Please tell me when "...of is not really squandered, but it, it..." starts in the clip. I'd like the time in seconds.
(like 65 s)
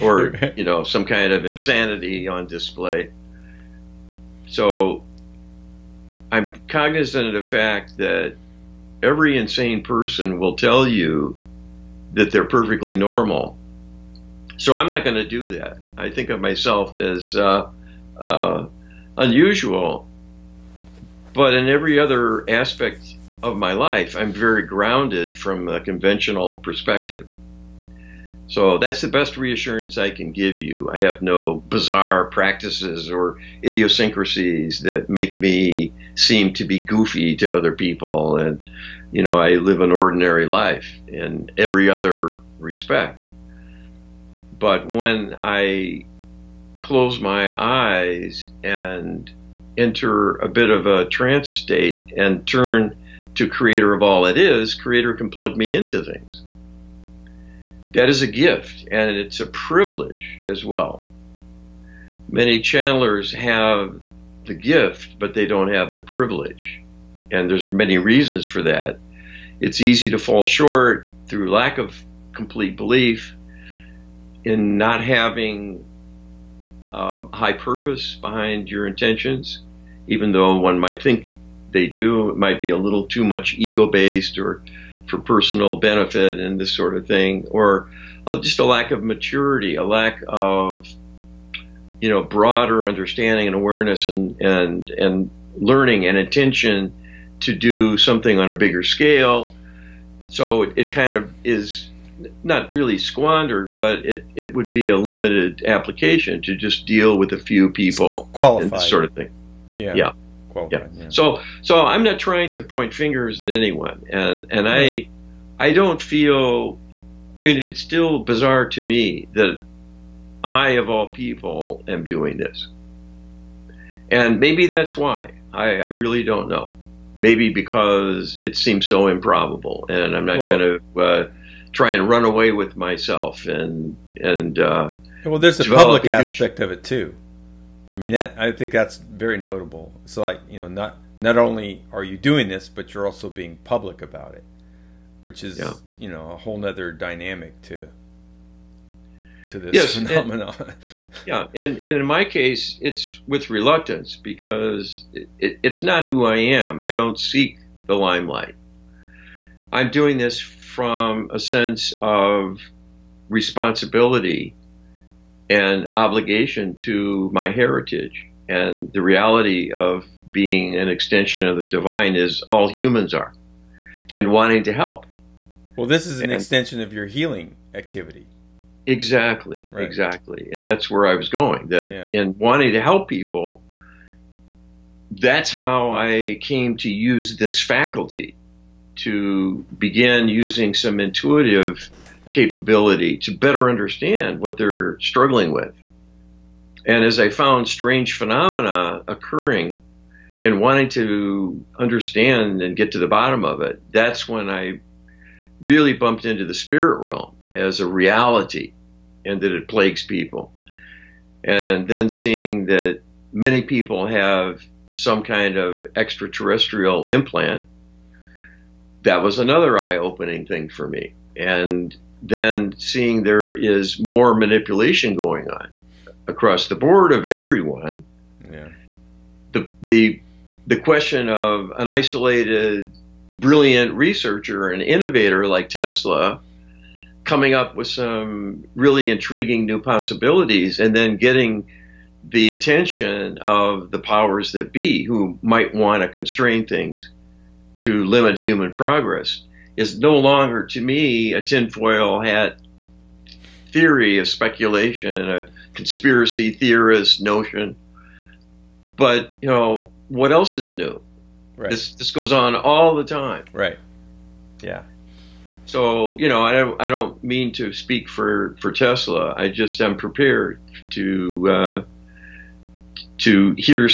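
101 s.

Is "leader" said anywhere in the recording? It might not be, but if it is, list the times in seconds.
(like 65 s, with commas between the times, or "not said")
not said.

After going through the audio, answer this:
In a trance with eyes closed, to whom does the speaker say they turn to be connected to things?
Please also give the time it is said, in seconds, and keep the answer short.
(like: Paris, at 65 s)
Creator of all it is, at 53 s.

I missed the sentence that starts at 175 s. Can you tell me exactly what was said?
Well, this is an and, extension of your healing activity.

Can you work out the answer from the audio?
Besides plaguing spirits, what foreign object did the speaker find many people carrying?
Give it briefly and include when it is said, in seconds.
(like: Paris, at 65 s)
Extraterrestrial implant, at 215 s.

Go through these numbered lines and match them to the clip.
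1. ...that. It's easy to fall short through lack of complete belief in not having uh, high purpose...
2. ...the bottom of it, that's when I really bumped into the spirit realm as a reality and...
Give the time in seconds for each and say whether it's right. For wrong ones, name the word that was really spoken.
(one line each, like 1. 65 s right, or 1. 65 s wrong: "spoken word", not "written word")
1. 68 s right
2. 202 s right.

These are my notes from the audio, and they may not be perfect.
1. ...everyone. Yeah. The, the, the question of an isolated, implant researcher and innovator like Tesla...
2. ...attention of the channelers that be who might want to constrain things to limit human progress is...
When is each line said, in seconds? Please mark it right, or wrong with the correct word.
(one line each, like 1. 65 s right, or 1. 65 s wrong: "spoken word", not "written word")
1. 227 s wrong: "brilliant", not "implant"
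2. 242 s wrong: "powers", not "channelers".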